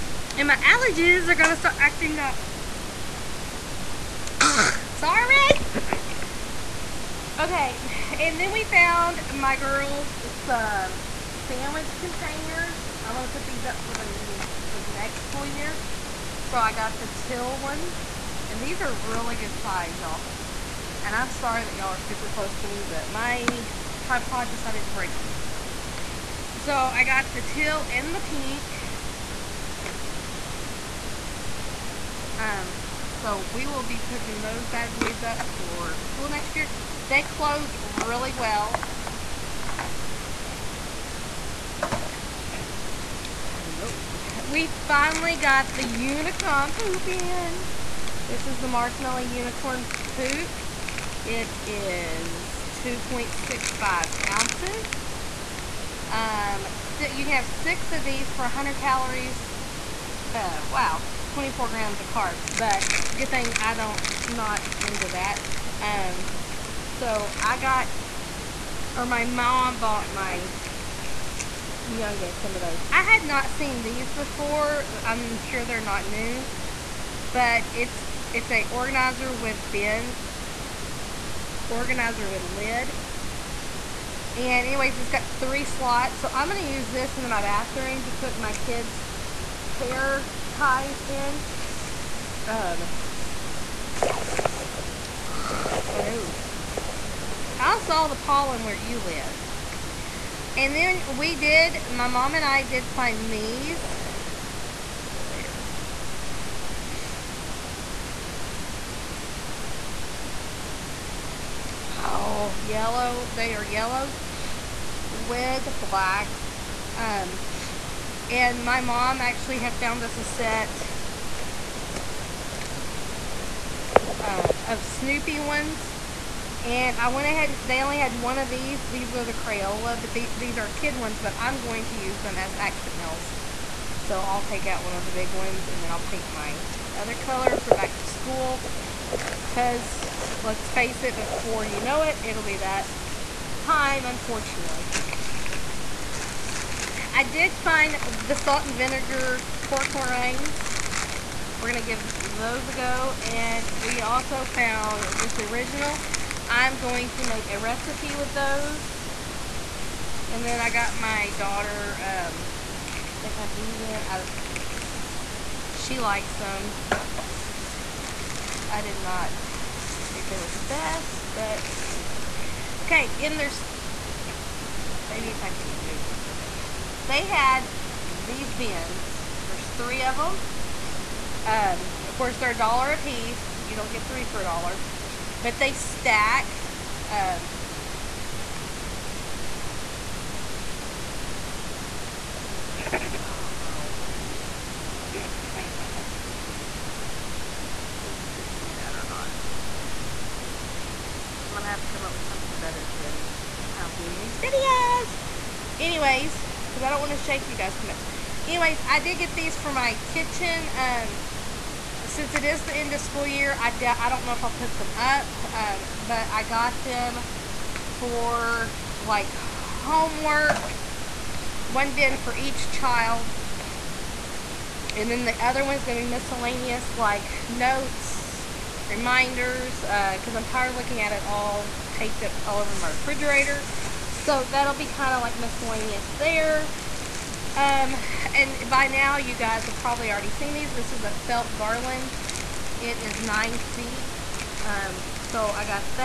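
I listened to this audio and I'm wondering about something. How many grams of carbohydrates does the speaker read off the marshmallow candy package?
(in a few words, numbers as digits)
24 grams.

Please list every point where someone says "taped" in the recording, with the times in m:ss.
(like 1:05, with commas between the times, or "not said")
3:51.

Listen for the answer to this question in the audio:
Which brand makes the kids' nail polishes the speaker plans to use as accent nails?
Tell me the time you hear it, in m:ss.
2:09.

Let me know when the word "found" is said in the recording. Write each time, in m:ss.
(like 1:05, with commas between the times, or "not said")
0:08, 1:59, 2:34.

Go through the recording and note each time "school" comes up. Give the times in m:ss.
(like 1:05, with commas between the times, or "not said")
0:15, 0:36, 2:18, 3:32.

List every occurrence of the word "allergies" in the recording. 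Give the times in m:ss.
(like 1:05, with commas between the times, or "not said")
0:00.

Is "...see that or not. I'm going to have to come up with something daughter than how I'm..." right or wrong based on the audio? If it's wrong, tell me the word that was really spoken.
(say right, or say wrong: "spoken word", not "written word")
wrong: "better", not "daughter".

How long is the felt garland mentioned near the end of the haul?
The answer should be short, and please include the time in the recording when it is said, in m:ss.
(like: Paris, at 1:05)
9 feet, at 4:03.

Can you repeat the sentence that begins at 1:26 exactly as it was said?
So I'm going to use this in my bathroom to put my kids' hair ties in.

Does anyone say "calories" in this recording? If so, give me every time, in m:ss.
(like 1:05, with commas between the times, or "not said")
0:58.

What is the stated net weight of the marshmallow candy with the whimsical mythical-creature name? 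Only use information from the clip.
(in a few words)
2.65 ounces.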